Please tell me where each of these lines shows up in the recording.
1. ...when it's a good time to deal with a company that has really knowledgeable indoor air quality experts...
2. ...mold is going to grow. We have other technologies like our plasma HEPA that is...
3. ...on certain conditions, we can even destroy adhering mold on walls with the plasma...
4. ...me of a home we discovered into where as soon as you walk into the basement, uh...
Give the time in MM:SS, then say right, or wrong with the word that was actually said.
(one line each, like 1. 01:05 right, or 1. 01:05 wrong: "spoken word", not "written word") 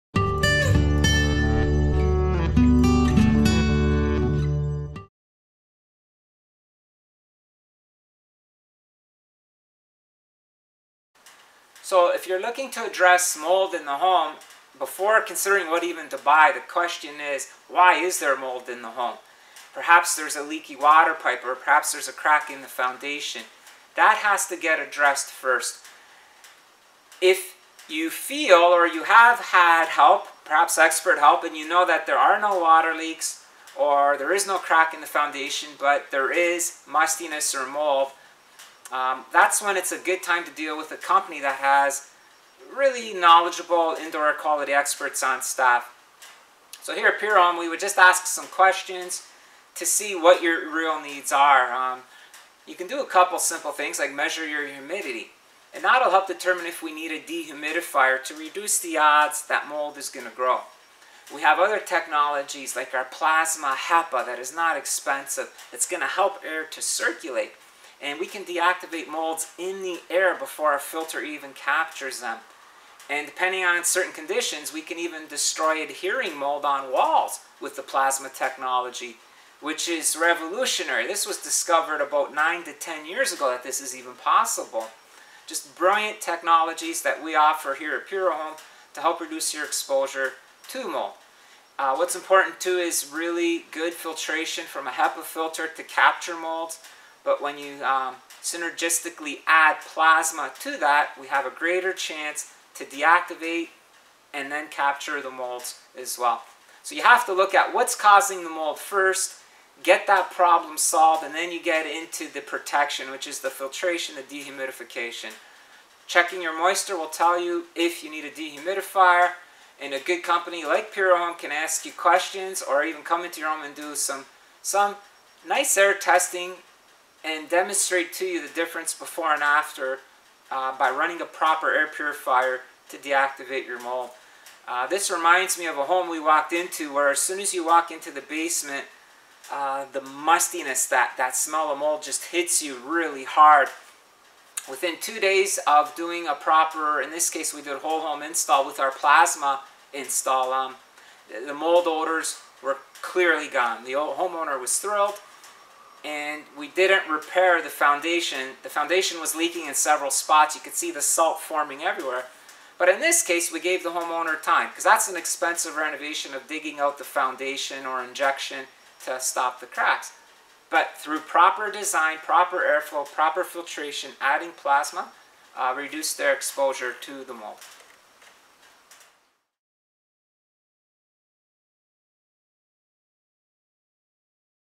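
1. 00:39 right
2. 00:59 right
3. 01:13 right
4. 02:15 wrong: "walked", not "discovered".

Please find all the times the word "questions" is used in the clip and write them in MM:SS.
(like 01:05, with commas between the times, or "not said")
00:16, 00:48, 02:01.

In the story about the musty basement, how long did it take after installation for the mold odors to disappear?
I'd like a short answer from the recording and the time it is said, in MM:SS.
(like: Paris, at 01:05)
2 days, at 02:25.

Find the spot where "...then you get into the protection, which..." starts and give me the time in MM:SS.
01:51.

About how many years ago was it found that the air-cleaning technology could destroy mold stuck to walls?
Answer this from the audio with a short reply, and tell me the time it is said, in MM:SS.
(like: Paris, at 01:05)
9 to 10 years, at 01:22.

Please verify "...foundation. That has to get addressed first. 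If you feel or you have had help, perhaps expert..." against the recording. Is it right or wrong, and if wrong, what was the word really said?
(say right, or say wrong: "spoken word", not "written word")
right.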